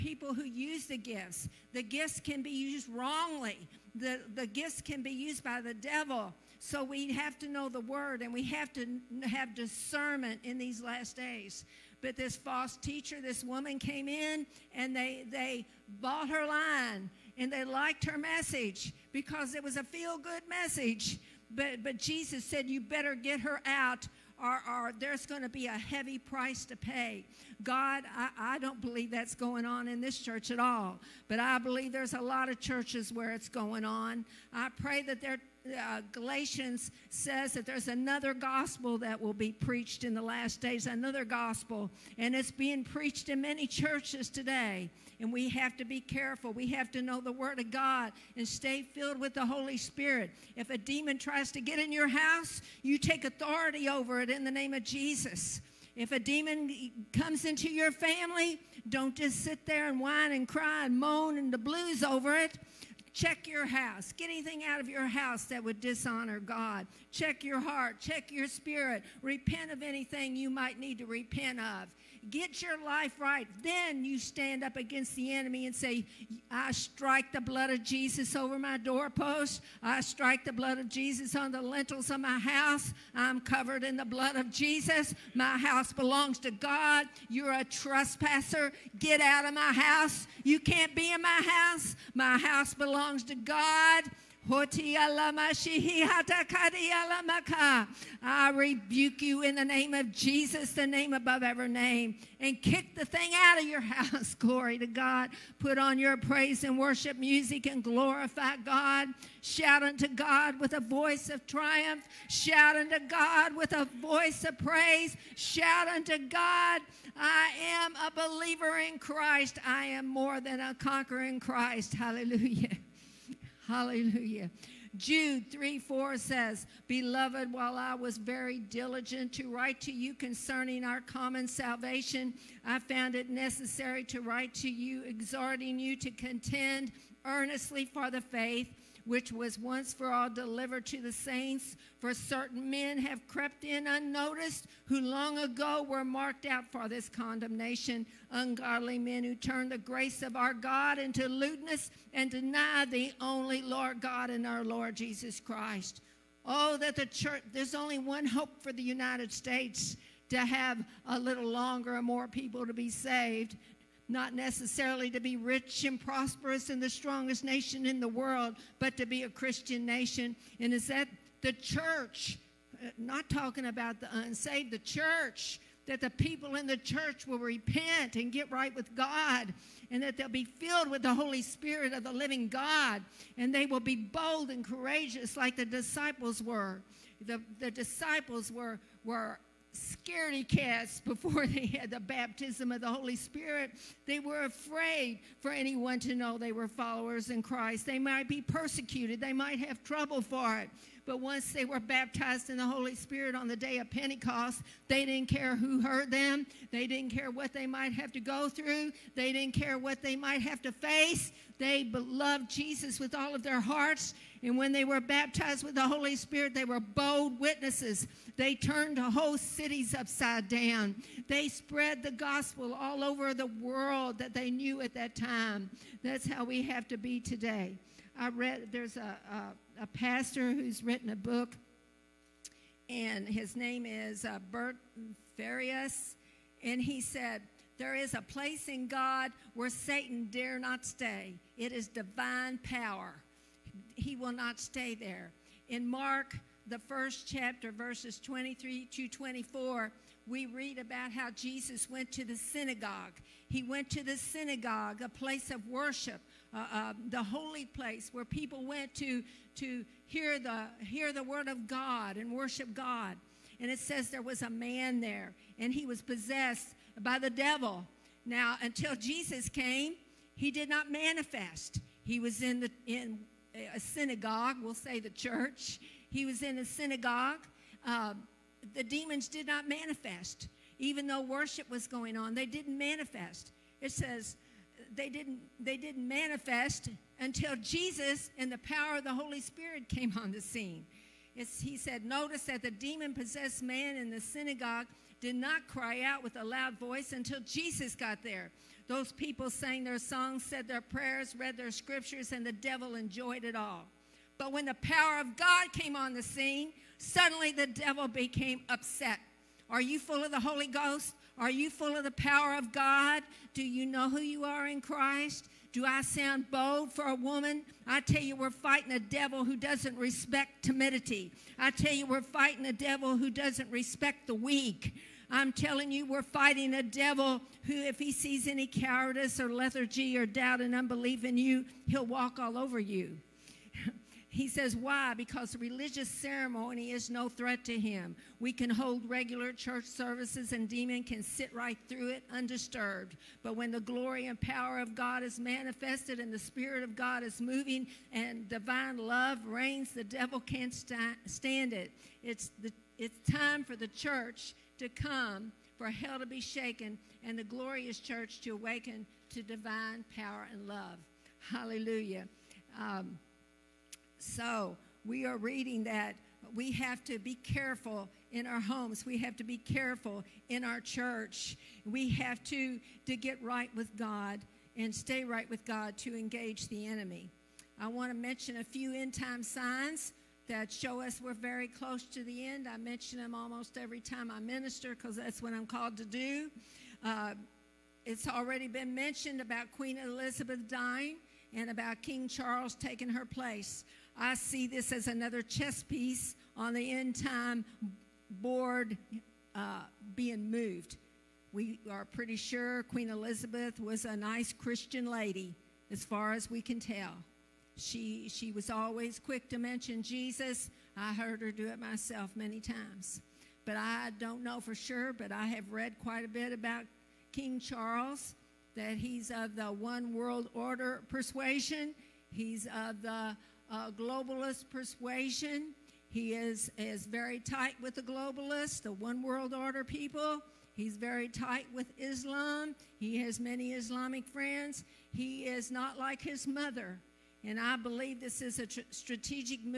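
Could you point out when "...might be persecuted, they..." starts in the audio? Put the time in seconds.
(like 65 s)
197 s.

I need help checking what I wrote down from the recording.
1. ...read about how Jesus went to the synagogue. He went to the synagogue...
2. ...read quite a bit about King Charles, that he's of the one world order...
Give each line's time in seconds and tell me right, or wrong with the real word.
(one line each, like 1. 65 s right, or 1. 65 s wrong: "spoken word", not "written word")
1. 250 s right
2. 415 s right.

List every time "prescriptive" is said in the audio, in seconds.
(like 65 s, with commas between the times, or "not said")
not said.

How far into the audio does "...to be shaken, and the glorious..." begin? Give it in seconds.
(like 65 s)
356 s.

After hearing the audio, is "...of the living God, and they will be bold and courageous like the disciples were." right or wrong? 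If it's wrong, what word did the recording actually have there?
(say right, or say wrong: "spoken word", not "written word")
right.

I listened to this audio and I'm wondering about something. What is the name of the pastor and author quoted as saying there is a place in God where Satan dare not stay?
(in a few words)
Bert Farias.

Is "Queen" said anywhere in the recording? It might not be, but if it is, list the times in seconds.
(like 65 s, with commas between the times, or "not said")
389 s, 402 s.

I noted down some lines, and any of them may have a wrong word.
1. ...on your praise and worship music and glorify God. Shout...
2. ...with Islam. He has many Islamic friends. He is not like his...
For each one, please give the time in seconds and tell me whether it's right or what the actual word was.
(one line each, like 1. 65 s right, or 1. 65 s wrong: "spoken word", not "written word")
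1. 105 s right
2. 431 s right.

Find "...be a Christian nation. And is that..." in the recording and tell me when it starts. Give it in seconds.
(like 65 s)
169 s.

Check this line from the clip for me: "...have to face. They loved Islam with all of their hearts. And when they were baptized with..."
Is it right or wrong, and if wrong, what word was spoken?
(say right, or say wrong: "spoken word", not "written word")
wrong: "Jesus", not "Islam".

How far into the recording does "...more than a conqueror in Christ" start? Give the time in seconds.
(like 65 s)
120 s.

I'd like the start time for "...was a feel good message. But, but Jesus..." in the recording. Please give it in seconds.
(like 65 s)
19 s.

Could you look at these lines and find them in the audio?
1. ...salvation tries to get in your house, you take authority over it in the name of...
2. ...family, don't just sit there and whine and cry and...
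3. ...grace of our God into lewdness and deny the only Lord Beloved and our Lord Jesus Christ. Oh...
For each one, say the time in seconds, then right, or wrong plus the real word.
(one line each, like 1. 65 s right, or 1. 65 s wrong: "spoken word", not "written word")
1. 50 s wrong: "demon", not "salvation"
2. 57 s right
3. 149 s wrong: "God", not "Beloved".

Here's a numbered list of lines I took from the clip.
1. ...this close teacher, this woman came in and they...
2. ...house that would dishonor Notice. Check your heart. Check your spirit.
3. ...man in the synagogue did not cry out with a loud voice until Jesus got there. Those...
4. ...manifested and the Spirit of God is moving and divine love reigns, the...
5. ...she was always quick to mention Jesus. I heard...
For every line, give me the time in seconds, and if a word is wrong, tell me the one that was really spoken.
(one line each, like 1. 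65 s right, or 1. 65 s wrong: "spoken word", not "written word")
1. 12 s wrong: "false", not "close"
2. 65 s wrong: "God", not "Notice"
3. 293 s right
4. 345 s right
5. 408 s right.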